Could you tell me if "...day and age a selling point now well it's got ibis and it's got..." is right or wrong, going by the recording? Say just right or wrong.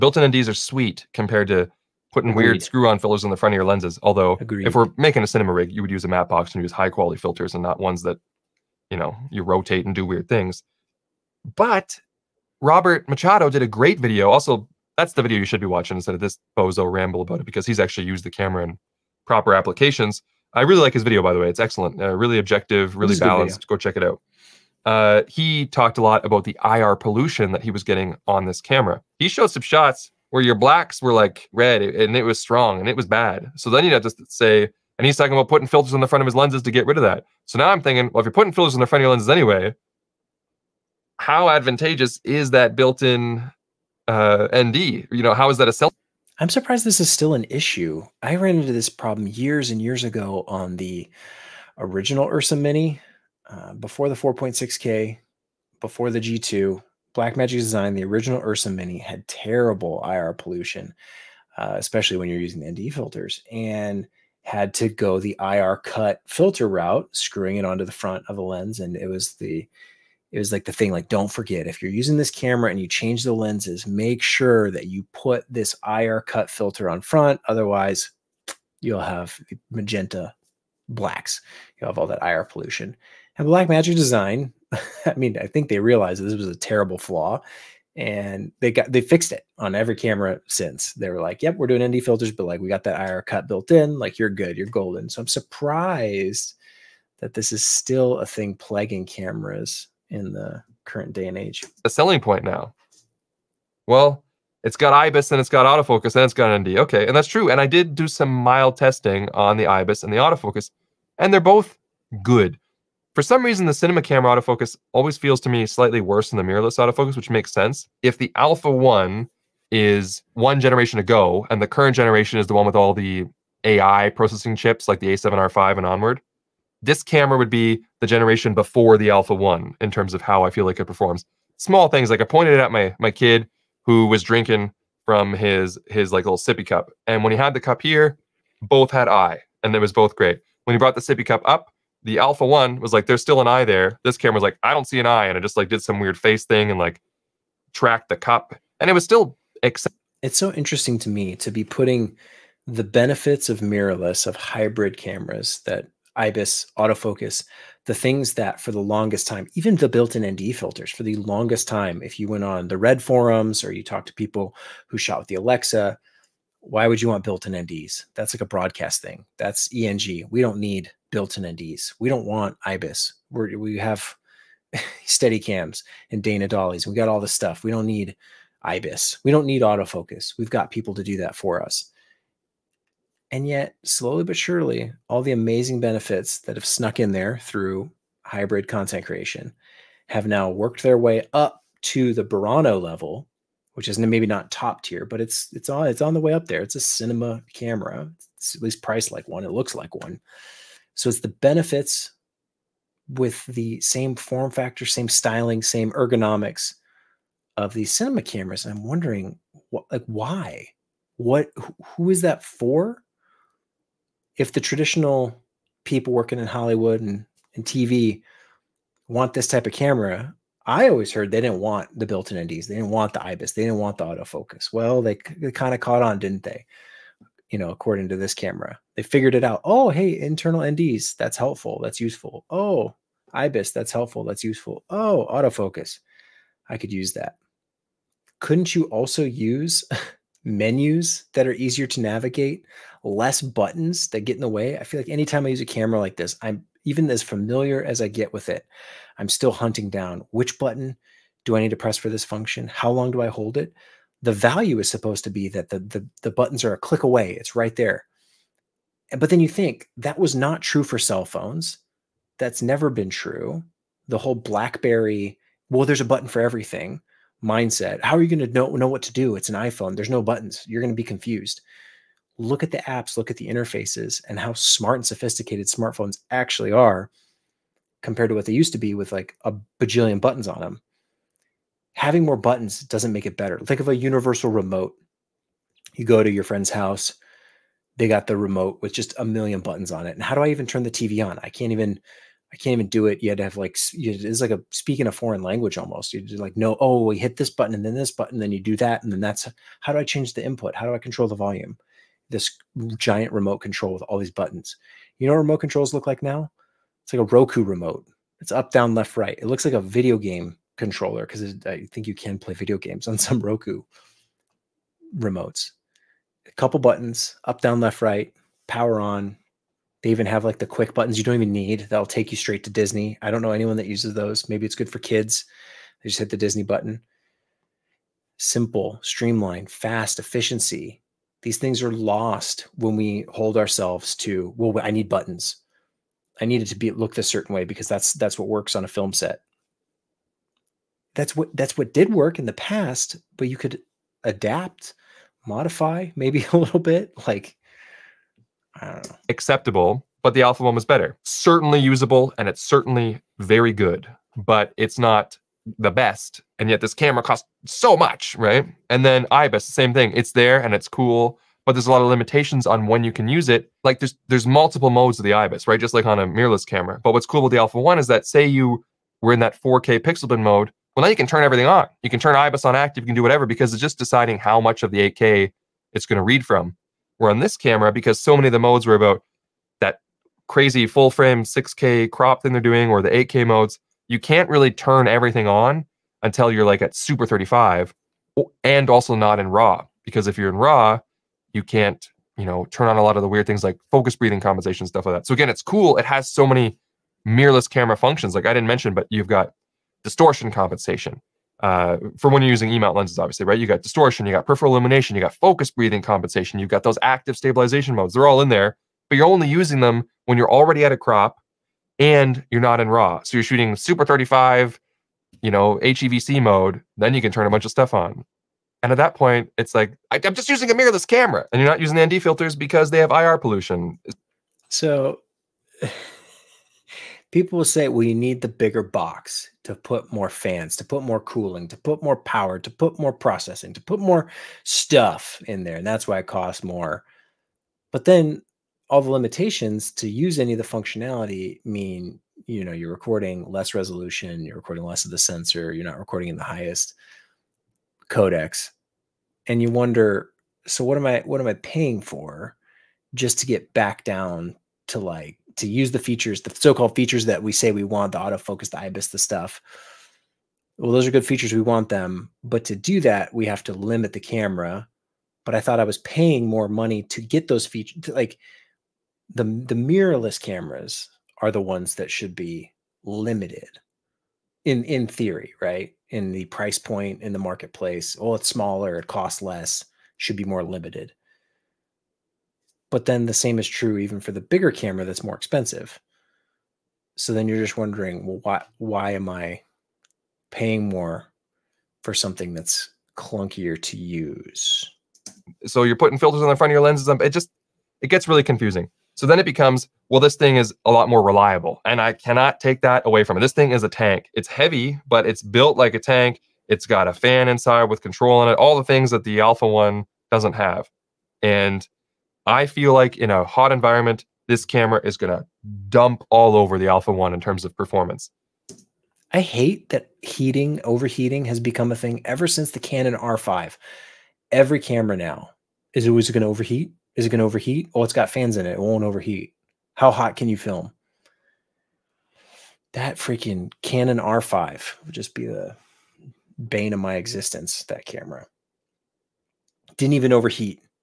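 right.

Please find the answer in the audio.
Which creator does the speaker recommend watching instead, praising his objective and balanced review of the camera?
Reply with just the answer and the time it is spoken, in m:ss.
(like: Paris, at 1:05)
Robert Machado, at 0:12.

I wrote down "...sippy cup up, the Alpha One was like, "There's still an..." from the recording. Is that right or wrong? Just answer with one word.
right.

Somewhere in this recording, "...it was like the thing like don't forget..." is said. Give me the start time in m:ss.
1:10.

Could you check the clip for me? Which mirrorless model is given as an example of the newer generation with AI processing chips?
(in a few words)
A7R5.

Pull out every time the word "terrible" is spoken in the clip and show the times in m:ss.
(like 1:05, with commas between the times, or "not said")
0:59, 1:26.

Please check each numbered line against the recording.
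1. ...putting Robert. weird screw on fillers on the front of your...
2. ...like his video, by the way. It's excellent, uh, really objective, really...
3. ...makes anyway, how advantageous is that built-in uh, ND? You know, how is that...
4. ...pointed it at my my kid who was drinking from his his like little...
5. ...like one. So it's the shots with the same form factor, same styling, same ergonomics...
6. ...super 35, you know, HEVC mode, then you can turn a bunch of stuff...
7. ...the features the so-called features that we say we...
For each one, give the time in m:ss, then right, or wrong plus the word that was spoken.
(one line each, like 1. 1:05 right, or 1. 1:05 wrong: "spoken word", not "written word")
1. 0:02 wrong: "Agreed", not "Robert"
2. 0:20 right
3. 0:39 wrong: "lenses", not "makes"
4. 2:12 right
5. 3:19 wrong: "benefits", not "shots"
6. 6:53 right
7. 7:35 right.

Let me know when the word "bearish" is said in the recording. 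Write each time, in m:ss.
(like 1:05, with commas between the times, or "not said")
not said.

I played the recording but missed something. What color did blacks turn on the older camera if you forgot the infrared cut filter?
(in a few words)
magenta.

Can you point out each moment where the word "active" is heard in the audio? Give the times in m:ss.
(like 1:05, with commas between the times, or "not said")
6:12, 6:47.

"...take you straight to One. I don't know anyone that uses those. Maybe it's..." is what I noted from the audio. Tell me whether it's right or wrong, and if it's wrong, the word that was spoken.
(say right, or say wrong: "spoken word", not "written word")
wrong: "Disney", not "One".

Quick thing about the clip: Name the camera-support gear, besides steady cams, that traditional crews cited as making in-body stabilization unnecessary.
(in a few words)
Dana dollies.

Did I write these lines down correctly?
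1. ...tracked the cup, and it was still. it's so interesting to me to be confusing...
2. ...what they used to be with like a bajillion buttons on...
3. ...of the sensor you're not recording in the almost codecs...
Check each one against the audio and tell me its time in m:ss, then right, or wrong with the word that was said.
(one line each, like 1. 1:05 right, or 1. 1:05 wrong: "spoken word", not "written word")
1. 2:27 wrong: "putting", not "confusing"
2. 4:38 right
3. 7:25 wrong: "highest", not "almost".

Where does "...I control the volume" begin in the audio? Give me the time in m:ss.
5:00.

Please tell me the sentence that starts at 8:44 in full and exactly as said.
Every camera now is always going to overheat is it going to overheat?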